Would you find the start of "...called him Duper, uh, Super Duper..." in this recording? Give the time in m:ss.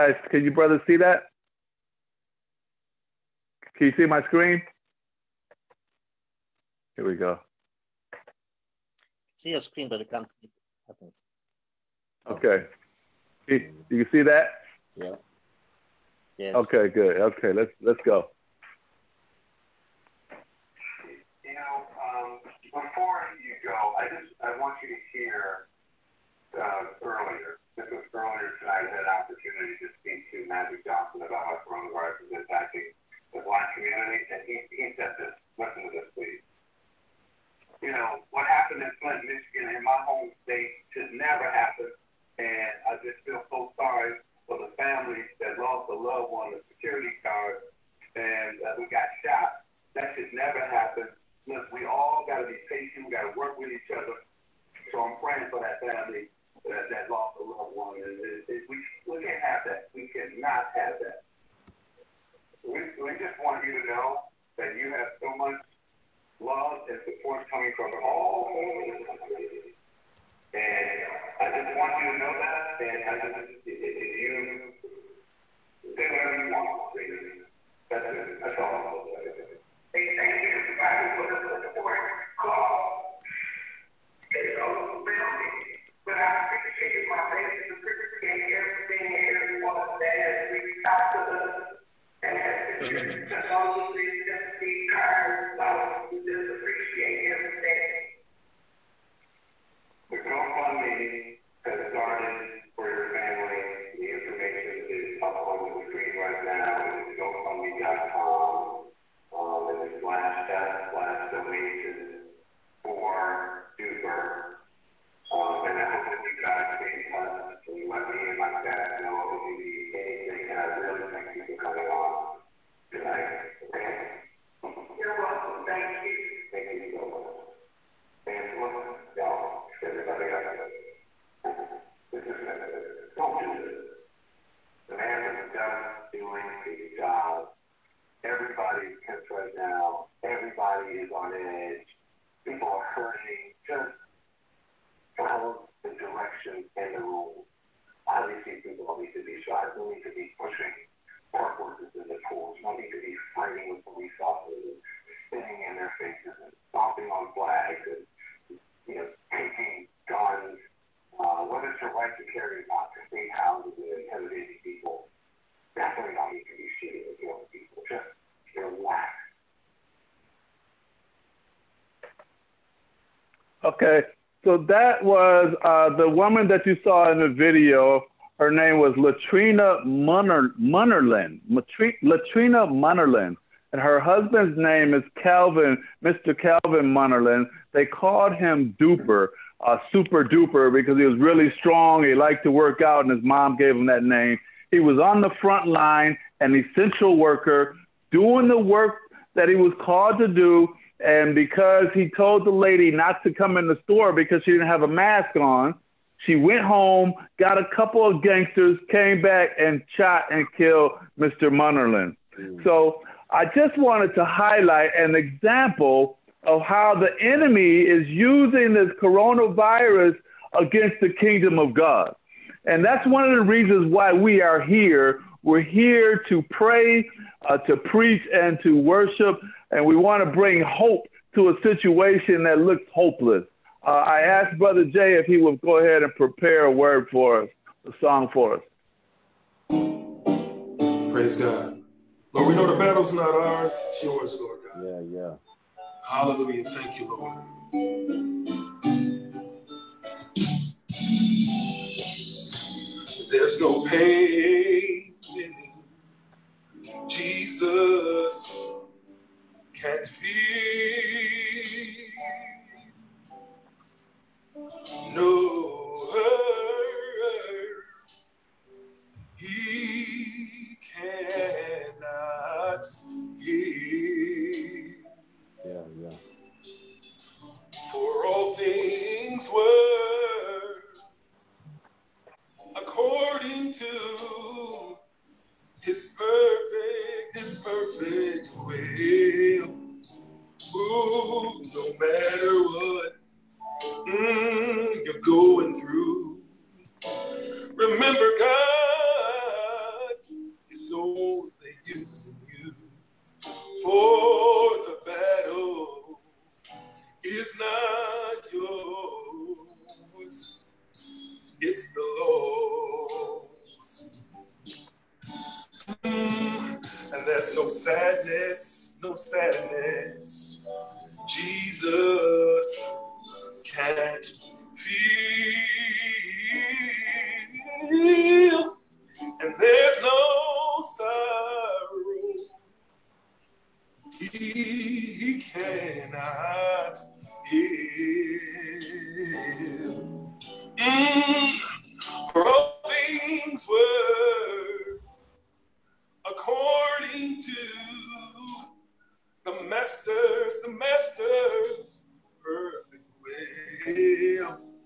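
3:07.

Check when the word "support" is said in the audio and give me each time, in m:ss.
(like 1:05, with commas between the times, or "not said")
1:07, 1:21.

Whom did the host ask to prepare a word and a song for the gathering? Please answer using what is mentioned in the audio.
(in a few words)
Brother Jay.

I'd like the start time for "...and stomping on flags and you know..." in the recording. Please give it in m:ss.
2:36.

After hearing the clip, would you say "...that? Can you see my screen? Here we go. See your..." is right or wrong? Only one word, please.
right.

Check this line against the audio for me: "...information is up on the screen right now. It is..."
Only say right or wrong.
right.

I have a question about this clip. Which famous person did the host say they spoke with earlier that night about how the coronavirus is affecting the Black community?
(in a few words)
Magic Johnson.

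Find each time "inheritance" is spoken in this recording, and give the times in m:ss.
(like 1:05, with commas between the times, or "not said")
not said.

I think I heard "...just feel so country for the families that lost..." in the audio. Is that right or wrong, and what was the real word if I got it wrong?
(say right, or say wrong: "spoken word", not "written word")
wrong: "sorry", not "country".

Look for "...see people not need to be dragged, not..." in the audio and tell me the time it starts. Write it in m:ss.
2:28.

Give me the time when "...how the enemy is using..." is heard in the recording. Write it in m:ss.
3:36.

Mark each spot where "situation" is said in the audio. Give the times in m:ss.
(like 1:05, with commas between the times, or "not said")
3:51.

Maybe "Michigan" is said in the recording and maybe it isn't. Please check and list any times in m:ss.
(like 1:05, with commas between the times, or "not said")
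0:39.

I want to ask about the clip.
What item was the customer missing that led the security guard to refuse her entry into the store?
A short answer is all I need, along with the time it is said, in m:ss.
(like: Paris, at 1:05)
A mask, at 3:24.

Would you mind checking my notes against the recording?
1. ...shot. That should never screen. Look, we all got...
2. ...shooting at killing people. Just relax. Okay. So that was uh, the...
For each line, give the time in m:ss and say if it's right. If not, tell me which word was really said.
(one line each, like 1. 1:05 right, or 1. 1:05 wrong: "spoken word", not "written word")
1. 0:49 wrong: "happen", not "screen"
2. 2:46 right.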